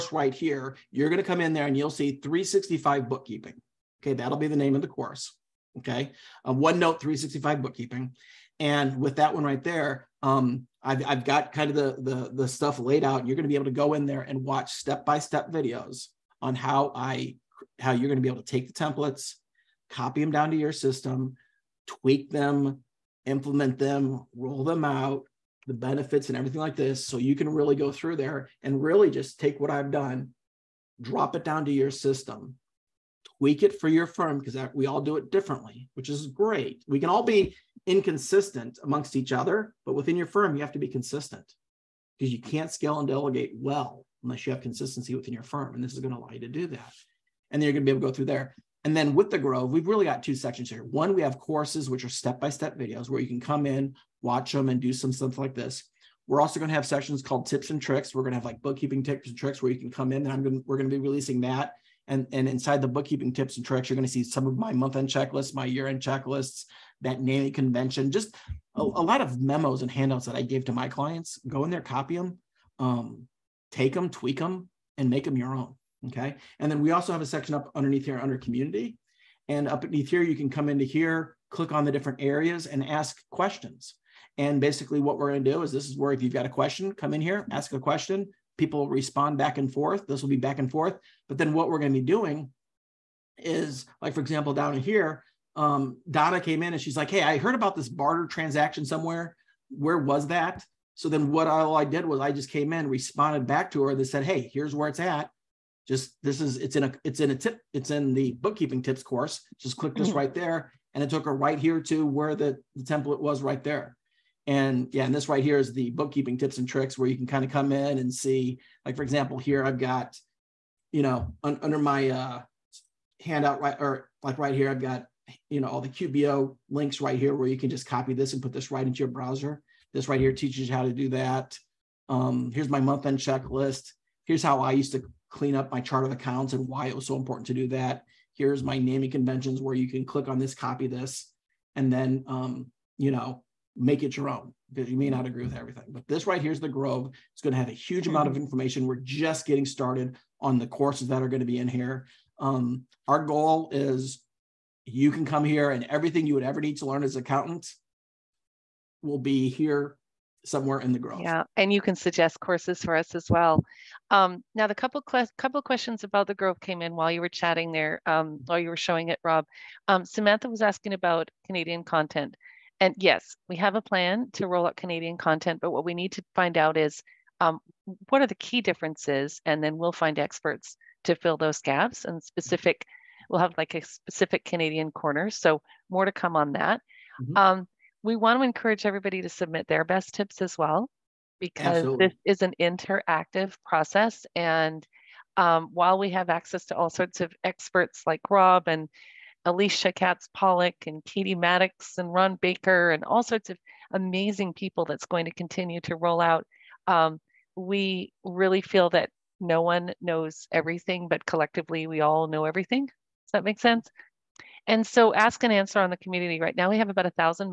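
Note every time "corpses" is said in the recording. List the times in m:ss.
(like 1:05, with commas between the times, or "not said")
not said.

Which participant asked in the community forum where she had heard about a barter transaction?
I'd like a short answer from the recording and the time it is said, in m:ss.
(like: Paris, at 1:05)
Donna, at 1:36.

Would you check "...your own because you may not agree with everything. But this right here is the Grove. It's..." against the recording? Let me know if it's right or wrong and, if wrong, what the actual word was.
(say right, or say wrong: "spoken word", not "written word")
right.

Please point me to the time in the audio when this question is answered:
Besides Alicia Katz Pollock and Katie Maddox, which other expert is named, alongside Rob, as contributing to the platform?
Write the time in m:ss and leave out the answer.
3:22.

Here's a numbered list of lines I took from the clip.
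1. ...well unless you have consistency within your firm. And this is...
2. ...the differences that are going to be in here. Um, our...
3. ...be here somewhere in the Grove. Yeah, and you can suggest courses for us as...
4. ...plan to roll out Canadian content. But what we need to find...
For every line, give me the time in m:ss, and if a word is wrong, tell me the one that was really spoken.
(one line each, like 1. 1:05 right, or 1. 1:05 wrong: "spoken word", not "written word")
1. 0:43 right
2. 2:30 wrong: "courses", not "differences"
3. 2:39 right
4. 2:53 right.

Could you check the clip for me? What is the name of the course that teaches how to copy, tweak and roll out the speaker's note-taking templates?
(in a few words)
OneNote 365 bookkeeping.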